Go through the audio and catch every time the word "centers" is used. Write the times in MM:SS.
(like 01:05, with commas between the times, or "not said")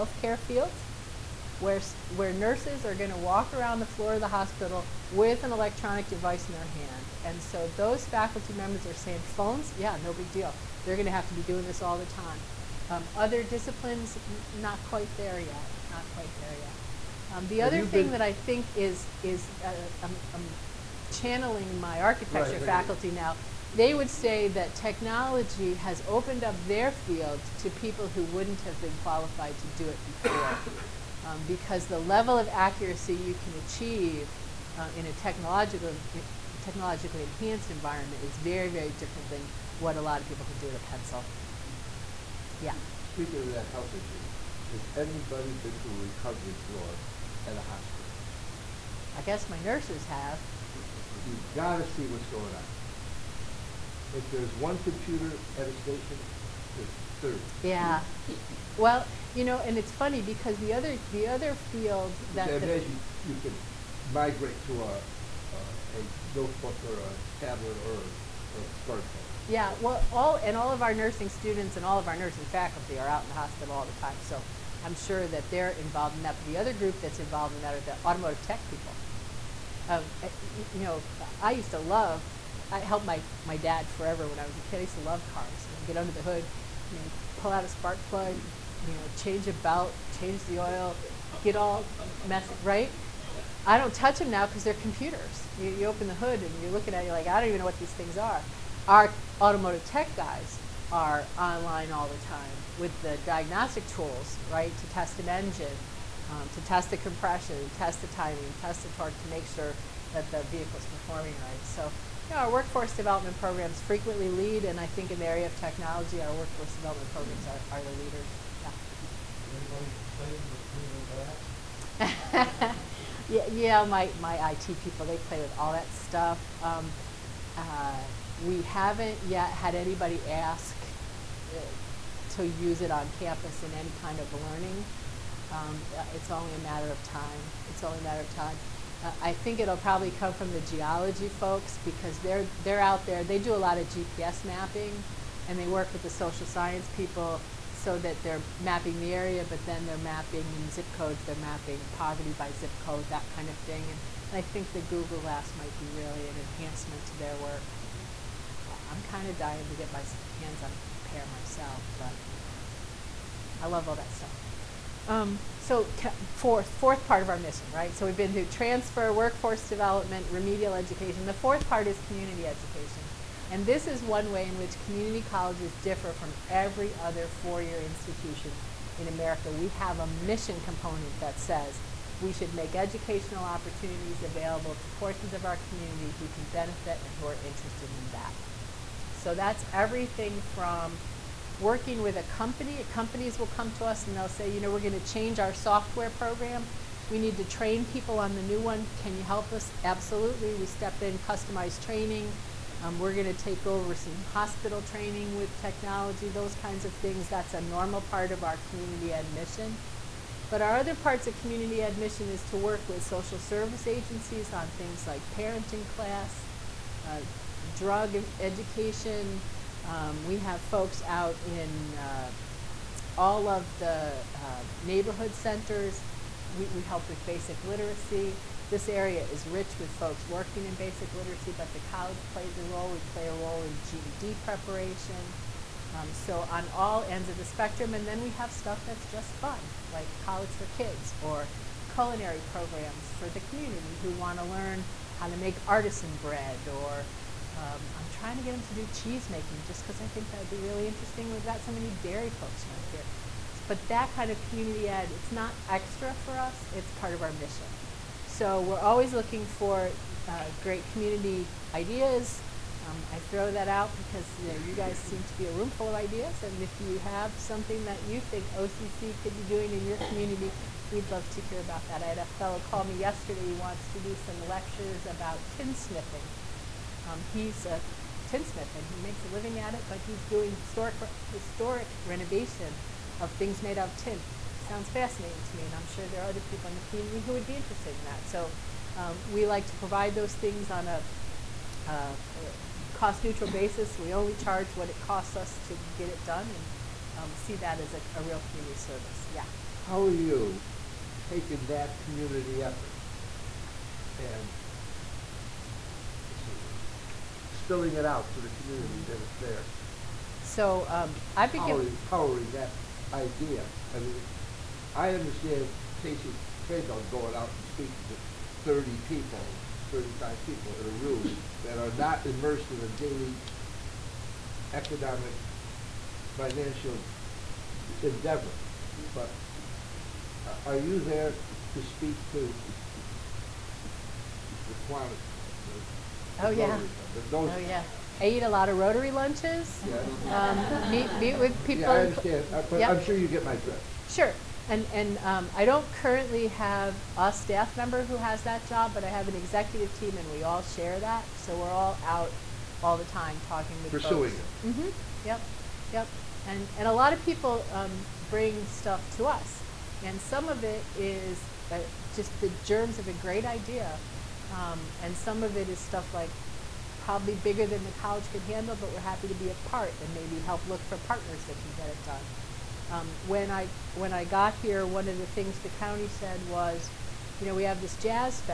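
03:45.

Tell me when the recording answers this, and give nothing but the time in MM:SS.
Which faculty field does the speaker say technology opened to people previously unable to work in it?
00:22.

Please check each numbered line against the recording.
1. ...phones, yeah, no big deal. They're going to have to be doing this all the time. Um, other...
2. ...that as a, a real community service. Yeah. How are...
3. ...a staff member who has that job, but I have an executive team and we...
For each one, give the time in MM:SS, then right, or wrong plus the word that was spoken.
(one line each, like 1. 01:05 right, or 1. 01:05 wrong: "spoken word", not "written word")
1. 00:09 right
2. 04:57 right
3. 05:47 right.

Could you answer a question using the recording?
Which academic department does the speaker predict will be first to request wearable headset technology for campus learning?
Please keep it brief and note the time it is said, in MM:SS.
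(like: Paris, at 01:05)
geology, at 02:20.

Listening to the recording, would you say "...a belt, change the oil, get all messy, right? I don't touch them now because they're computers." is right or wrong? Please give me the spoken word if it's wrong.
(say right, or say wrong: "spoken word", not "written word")
right.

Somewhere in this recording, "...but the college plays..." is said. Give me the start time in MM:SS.
03:51.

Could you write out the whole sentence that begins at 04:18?
So we're always looking for uh, great community ideas.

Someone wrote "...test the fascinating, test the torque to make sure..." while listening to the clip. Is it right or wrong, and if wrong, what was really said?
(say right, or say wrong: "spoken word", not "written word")
wrong: "timing", not "fascinating".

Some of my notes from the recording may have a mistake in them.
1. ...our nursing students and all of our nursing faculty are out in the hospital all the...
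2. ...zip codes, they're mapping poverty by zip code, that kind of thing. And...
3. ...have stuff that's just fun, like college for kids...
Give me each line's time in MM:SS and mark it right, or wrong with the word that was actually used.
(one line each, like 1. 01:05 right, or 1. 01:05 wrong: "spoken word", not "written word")
1. 01:10 right
2. 02:30 right
3. 03:58 right.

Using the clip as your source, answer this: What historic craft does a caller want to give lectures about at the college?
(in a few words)
tinsmithing.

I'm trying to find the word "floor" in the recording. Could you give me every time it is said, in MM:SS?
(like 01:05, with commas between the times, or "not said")
00:03, 00:46.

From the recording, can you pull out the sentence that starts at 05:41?
yeah, I understand, Uh, but I'm sure you get my drift.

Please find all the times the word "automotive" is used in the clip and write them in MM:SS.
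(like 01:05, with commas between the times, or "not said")
01:18, 01:39.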